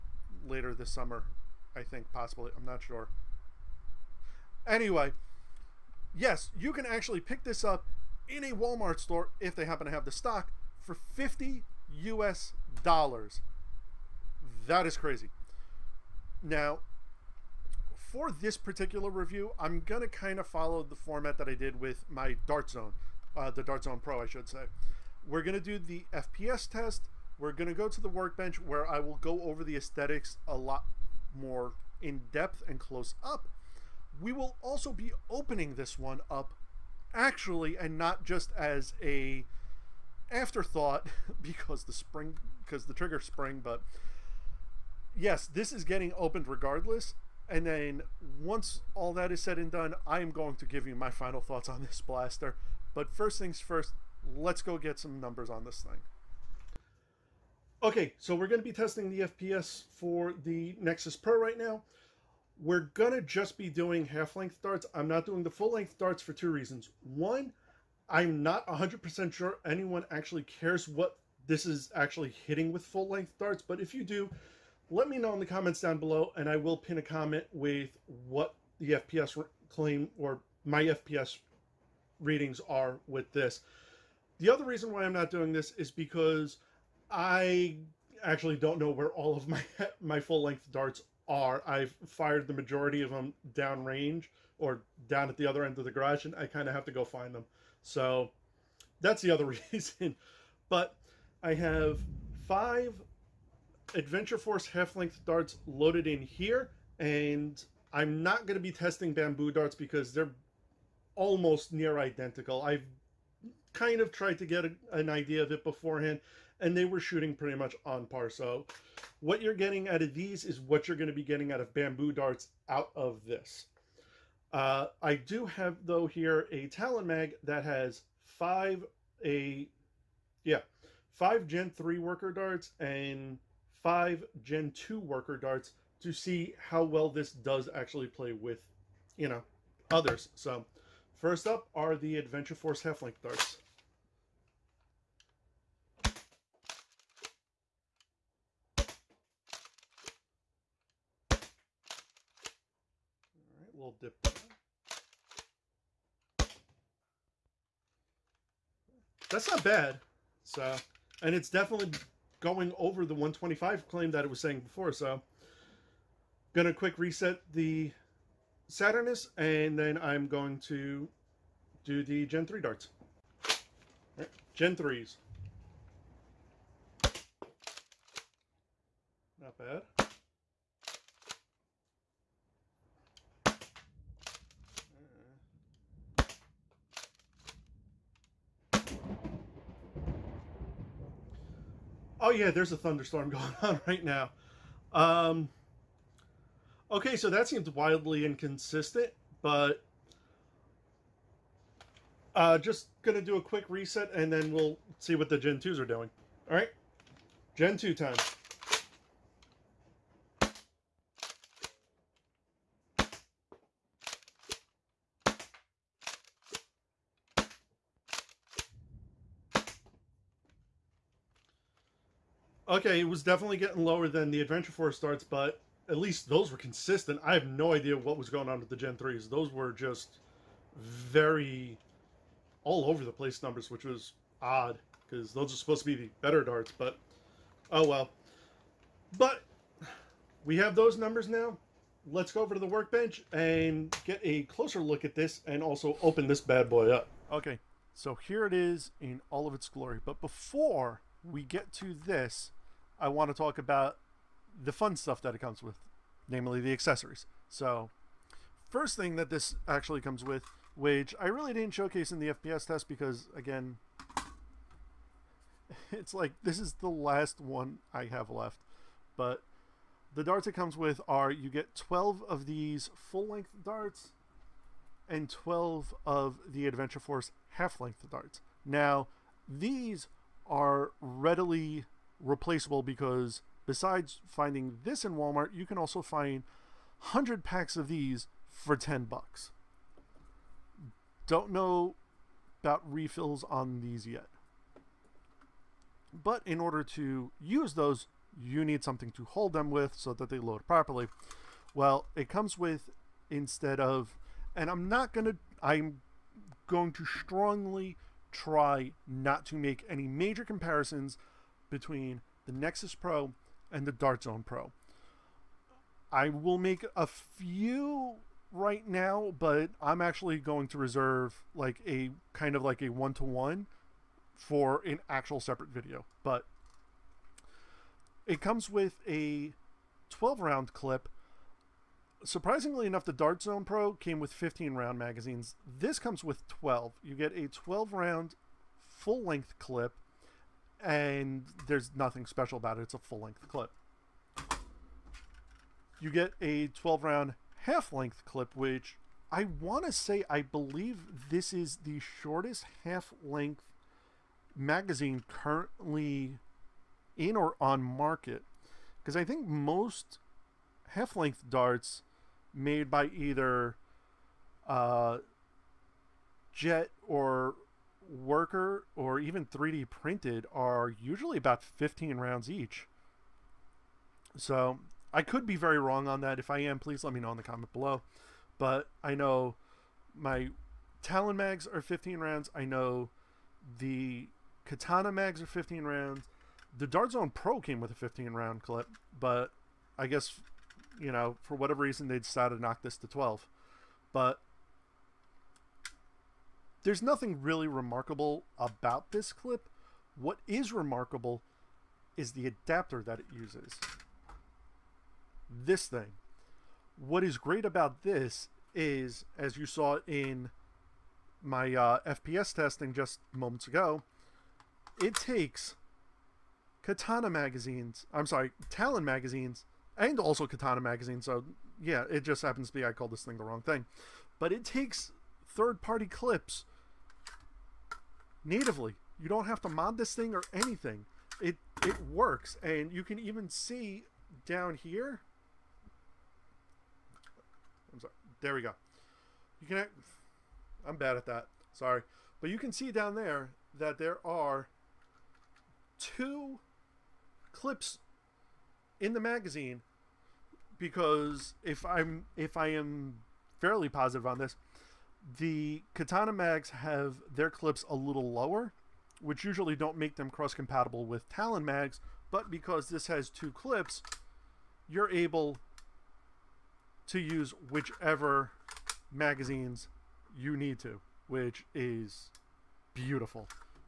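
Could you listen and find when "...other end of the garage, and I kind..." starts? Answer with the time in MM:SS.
01:35.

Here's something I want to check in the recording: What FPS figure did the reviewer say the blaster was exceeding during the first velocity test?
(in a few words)
125.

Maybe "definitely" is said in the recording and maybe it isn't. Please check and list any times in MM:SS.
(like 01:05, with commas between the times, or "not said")
02:41, 03:43.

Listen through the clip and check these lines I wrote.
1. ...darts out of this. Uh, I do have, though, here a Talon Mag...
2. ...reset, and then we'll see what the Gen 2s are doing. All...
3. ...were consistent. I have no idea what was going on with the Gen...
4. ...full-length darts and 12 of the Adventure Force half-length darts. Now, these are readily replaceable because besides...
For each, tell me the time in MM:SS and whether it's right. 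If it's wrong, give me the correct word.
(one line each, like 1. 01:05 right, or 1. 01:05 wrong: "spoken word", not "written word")
1. 02:02 right
2. 03:23 right
3. 03:46 right
4. 04:32 right.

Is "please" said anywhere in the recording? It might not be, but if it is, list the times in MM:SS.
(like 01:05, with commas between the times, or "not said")
06:16.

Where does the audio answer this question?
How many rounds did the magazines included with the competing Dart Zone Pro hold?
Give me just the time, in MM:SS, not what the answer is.
05:34.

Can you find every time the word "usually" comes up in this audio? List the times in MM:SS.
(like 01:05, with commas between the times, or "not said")
06:11, 07:39.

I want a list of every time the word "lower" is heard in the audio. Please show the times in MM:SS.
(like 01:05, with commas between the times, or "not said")
03:43, 07:38.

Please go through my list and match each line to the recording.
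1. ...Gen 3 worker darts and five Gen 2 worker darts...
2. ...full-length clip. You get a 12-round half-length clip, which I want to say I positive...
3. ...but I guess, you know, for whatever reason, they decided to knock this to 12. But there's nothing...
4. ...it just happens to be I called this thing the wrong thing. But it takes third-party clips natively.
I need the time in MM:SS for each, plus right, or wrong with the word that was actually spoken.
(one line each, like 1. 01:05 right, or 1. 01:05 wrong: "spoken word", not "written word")
1. 02:11 right
2. 05:42 wrong: "believe", not "positive"
3. 06:29 right
4. 07:02 right.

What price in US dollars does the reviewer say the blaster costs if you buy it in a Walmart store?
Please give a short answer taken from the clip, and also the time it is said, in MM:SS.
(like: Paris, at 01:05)
50, at 00:10.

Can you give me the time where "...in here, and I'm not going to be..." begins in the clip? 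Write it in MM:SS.
01:46.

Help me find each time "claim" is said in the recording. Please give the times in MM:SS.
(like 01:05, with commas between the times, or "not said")
01:19, 02:43.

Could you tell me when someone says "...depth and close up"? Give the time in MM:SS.
00:32.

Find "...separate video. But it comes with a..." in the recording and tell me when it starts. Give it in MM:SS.
05:25.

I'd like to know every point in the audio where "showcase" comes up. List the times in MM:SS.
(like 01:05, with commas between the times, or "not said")
04:21.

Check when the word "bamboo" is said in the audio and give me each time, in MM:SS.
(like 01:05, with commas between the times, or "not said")
01:49, 02:01.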